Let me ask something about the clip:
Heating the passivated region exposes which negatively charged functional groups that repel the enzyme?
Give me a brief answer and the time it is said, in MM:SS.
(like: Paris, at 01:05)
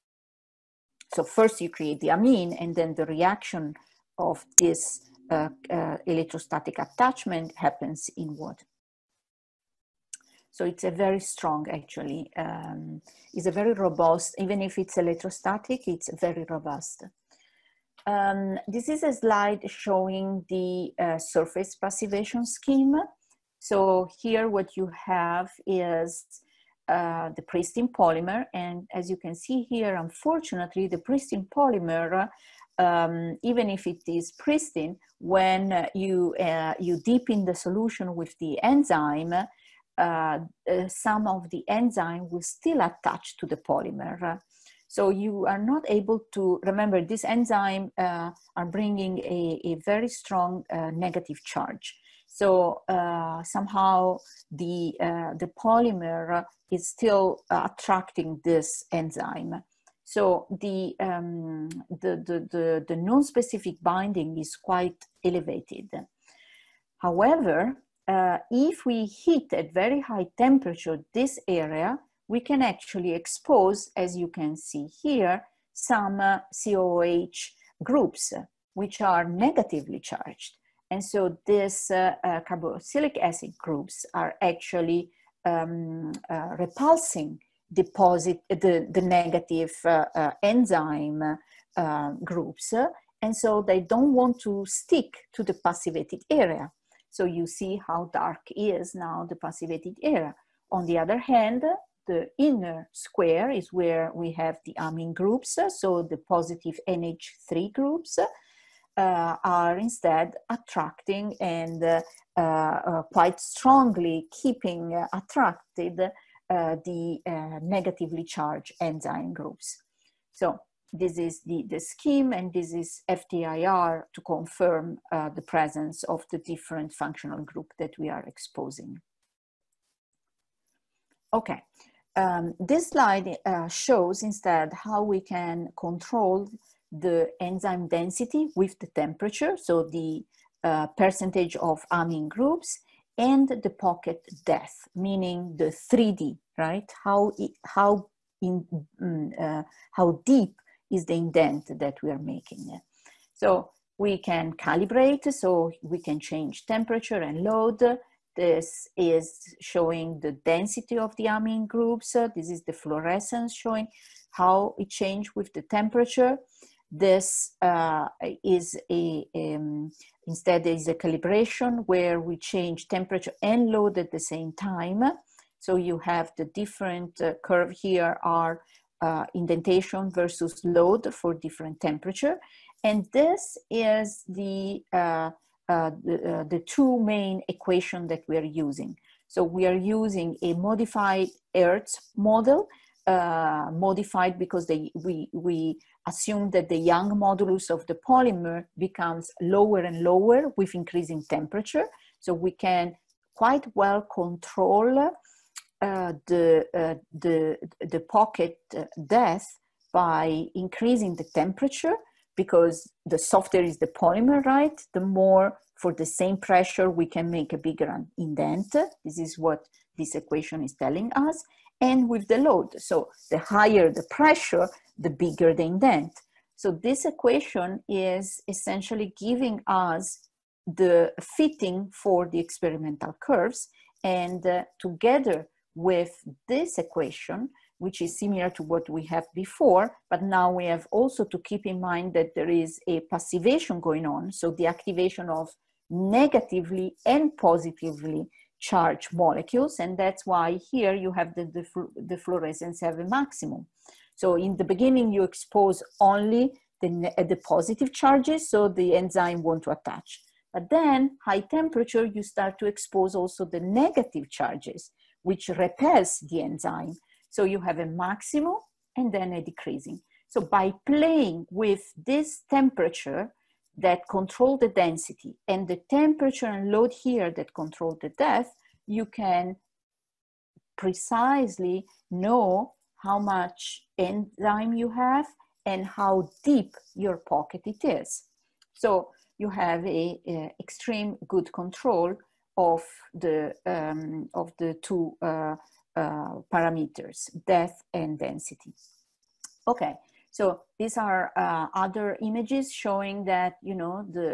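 Carboxylic acid groups, at 01:22.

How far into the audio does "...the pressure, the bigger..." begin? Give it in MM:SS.
03:43.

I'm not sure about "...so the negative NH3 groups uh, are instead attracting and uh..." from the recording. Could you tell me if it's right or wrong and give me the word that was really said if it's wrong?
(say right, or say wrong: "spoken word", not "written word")
wrong: "positive", not "negative".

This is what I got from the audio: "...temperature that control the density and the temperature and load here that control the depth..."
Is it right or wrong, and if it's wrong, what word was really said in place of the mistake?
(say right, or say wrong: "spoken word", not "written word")
right.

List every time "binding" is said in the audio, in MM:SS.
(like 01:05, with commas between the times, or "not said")
01:03.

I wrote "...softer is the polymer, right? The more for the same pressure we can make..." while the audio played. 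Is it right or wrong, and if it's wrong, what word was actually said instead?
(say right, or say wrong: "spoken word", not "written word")
right.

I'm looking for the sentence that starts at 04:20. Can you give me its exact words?
But then high temperature, you start to expose also the negative charges, which repels the enzyme.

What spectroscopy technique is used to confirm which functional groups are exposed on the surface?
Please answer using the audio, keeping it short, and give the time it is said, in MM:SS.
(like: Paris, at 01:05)
FTIR, at 02:03.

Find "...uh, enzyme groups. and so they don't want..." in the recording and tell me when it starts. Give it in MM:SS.
01:30.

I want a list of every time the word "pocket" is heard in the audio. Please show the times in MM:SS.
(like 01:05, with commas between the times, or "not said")
02:23, 03:27, 04:47.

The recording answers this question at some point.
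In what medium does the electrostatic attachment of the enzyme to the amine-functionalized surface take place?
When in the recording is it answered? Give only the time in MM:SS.
00:08.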